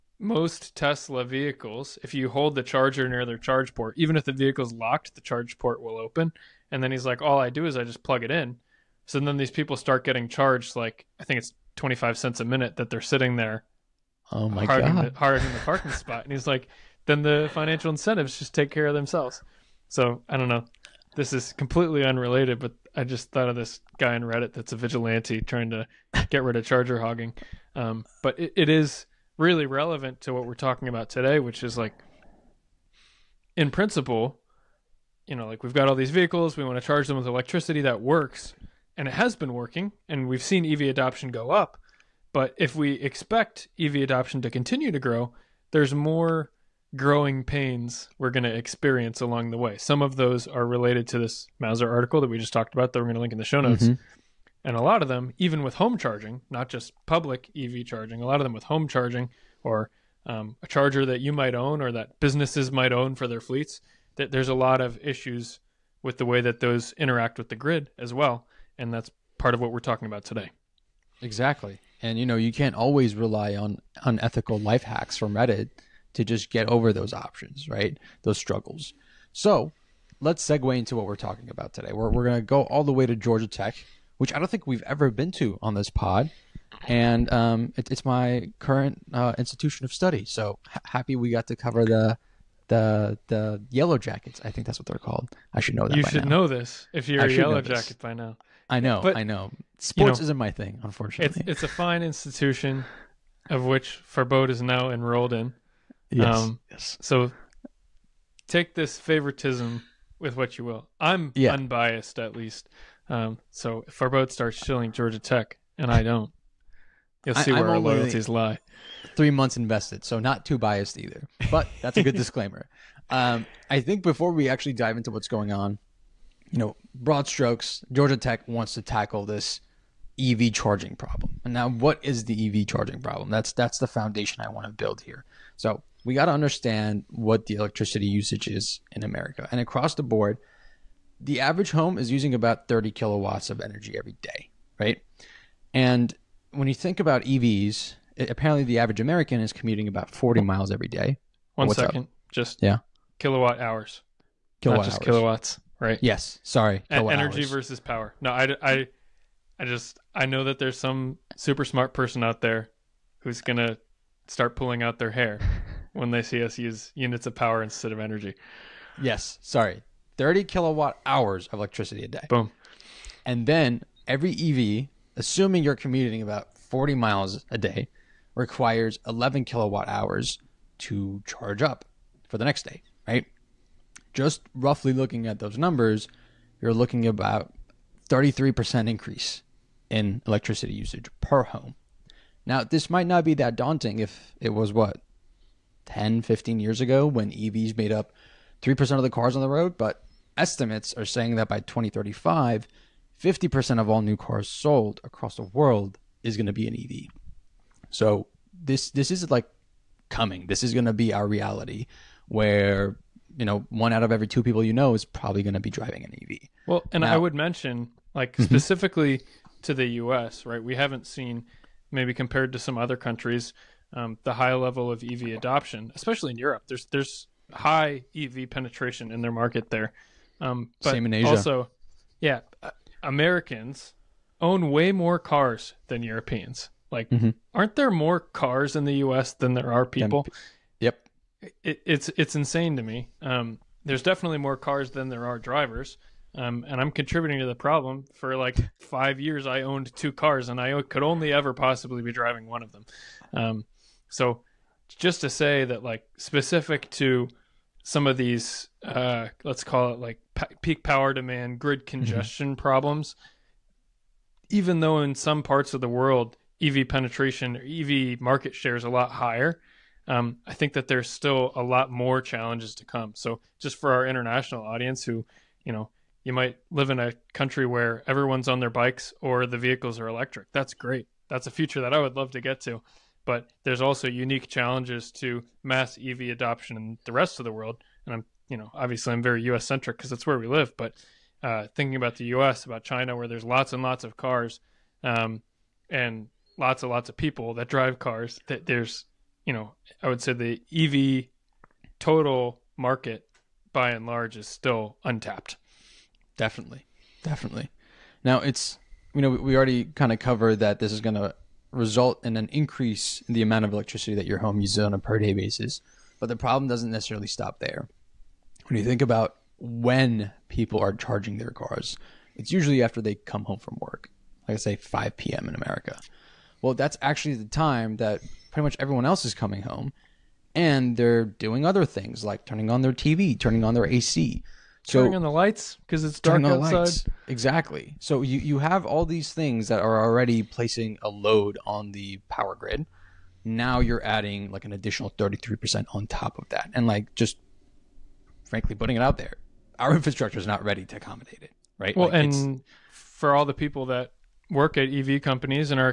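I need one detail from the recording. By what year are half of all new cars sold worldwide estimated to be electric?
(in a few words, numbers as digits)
2035.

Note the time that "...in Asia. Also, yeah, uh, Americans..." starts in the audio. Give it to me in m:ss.
3:51.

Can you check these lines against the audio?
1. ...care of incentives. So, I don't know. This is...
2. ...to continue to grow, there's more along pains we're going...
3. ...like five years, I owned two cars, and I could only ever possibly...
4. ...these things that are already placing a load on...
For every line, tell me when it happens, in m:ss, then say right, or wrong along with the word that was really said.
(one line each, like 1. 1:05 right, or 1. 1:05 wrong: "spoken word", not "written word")
1. 0:18 wrong: "themselves", not "incentives"
2. 0:44 wrong: "growing", not "along"
3. 4:08 right
4. 5:39 right.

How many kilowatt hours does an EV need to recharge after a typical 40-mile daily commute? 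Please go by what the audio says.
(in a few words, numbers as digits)
11 kilowatt hours.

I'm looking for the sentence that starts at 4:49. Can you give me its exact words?
centric because that's where we live.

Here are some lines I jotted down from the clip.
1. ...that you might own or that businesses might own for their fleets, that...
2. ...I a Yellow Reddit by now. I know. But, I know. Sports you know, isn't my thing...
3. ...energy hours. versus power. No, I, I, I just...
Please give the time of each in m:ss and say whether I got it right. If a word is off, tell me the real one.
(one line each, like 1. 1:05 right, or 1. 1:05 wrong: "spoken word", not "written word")
1. 1:01 right
2. 1:37 wrong: "Jacket", not "Reddit"
3. 2:36 right.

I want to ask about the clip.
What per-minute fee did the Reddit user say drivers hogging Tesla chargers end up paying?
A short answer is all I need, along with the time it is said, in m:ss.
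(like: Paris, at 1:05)
25 cents, at 0:11.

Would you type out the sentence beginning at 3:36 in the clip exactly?
Well, and now, I would mention like mm-hmm.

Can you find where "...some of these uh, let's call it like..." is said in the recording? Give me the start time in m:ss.
4:17.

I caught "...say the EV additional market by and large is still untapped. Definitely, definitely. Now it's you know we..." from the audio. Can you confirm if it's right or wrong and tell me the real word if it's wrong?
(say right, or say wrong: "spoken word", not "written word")
wrong: "total", not "additional".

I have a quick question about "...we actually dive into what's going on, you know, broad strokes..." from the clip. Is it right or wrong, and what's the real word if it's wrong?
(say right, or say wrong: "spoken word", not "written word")
right.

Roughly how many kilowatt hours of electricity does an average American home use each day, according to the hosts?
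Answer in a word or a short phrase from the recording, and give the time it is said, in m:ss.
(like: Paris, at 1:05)
30 kilowatt hours, at 2:50.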